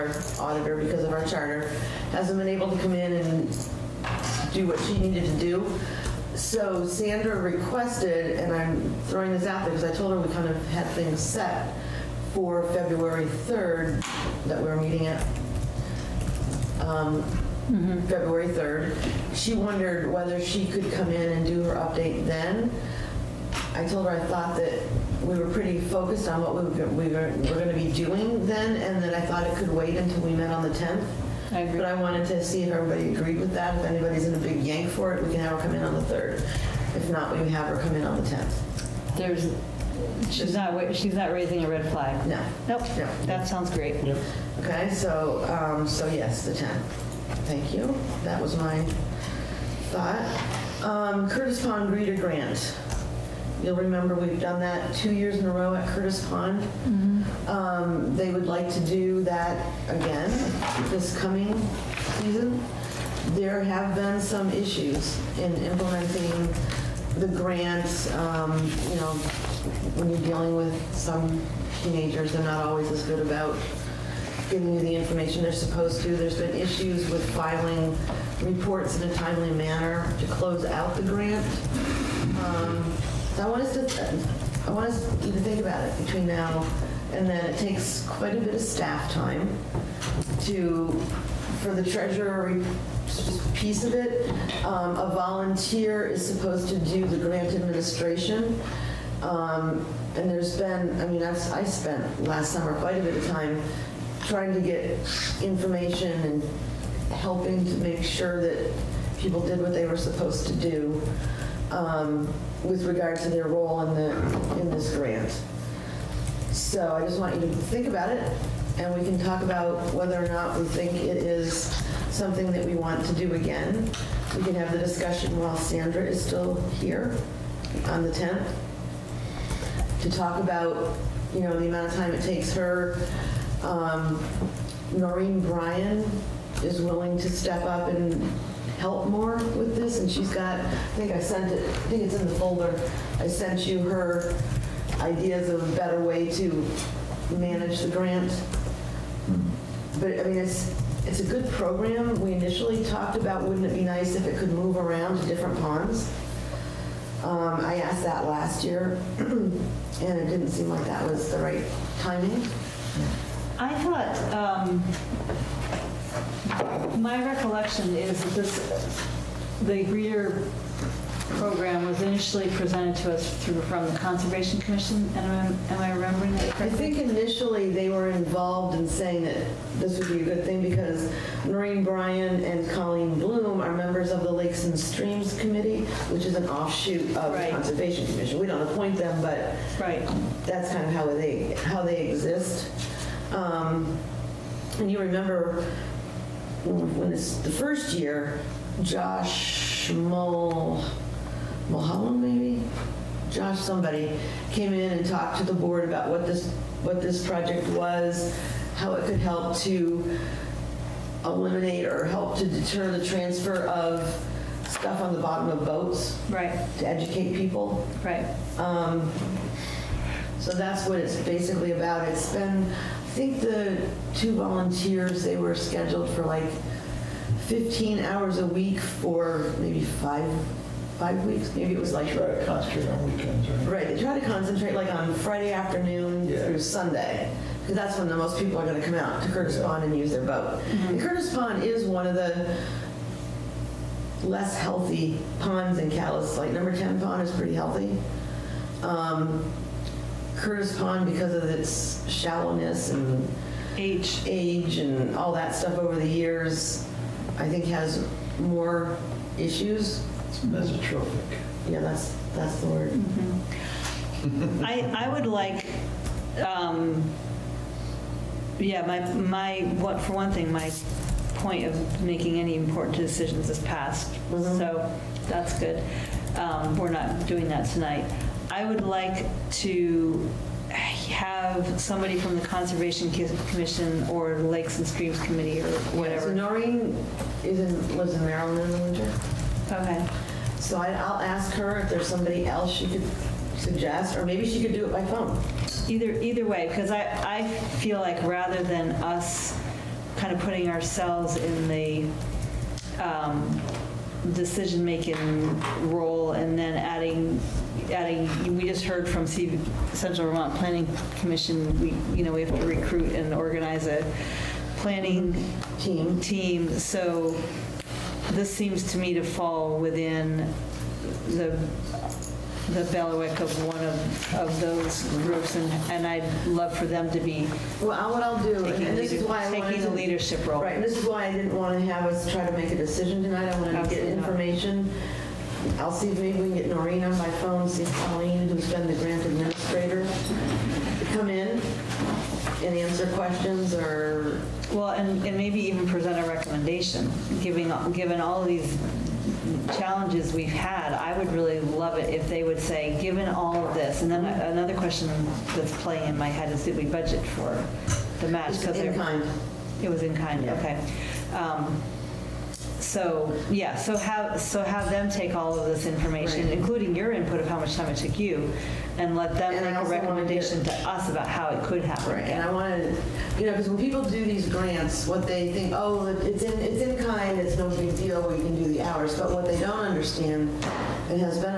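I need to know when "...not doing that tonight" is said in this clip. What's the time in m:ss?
4:36.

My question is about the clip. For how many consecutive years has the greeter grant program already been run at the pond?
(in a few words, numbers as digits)
2.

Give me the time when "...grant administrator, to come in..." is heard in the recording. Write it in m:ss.
5:38.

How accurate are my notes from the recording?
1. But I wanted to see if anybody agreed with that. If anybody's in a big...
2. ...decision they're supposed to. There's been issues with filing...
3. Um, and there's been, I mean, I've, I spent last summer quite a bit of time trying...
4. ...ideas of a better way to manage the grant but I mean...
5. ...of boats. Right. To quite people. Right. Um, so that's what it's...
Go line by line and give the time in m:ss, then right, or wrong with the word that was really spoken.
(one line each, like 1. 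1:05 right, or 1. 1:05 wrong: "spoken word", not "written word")
1. 0:31 wrong: "everybody", not "anybody"
2. 1:14 wrong: "information", not "decision"
3. 1:39 right
4. 2:24 right
5. 3:35 wrong: "educate", not "quite".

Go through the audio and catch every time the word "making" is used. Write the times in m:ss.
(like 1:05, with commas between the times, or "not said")
4:32, 5:04.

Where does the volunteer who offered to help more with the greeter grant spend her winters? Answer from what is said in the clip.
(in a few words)
Maryland.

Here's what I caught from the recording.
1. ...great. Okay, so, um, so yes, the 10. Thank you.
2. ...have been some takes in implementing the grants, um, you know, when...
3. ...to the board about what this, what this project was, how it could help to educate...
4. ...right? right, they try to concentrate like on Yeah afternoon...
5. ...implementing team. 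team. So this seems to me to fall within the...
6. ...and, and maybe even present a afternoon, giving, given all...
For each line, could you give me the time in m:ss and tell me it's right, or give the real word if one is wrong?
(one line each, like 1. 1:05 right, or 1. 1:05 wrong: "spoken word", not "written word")
1. 0:43 right
2. 1:03 wrong: "issues", not "takes"
3. 3:25 wrong: "eliminate", not "educate"
4. 3:53 wrong: "Friday", not "Yeah"
5. 5:14 wrong: "planning", not "implementing"
6. 5:44 wrong: "recommendation", not "afternoon".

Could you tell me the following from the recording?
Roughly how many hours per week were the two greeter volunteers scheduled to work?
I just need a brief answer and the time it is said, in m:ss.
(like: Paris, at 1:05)
15, at 3:47.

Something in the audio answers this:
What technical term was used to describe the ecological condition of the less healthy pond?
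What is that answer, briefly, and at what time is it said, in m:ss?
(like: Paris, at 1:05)
Mesotrophic, at 4:20.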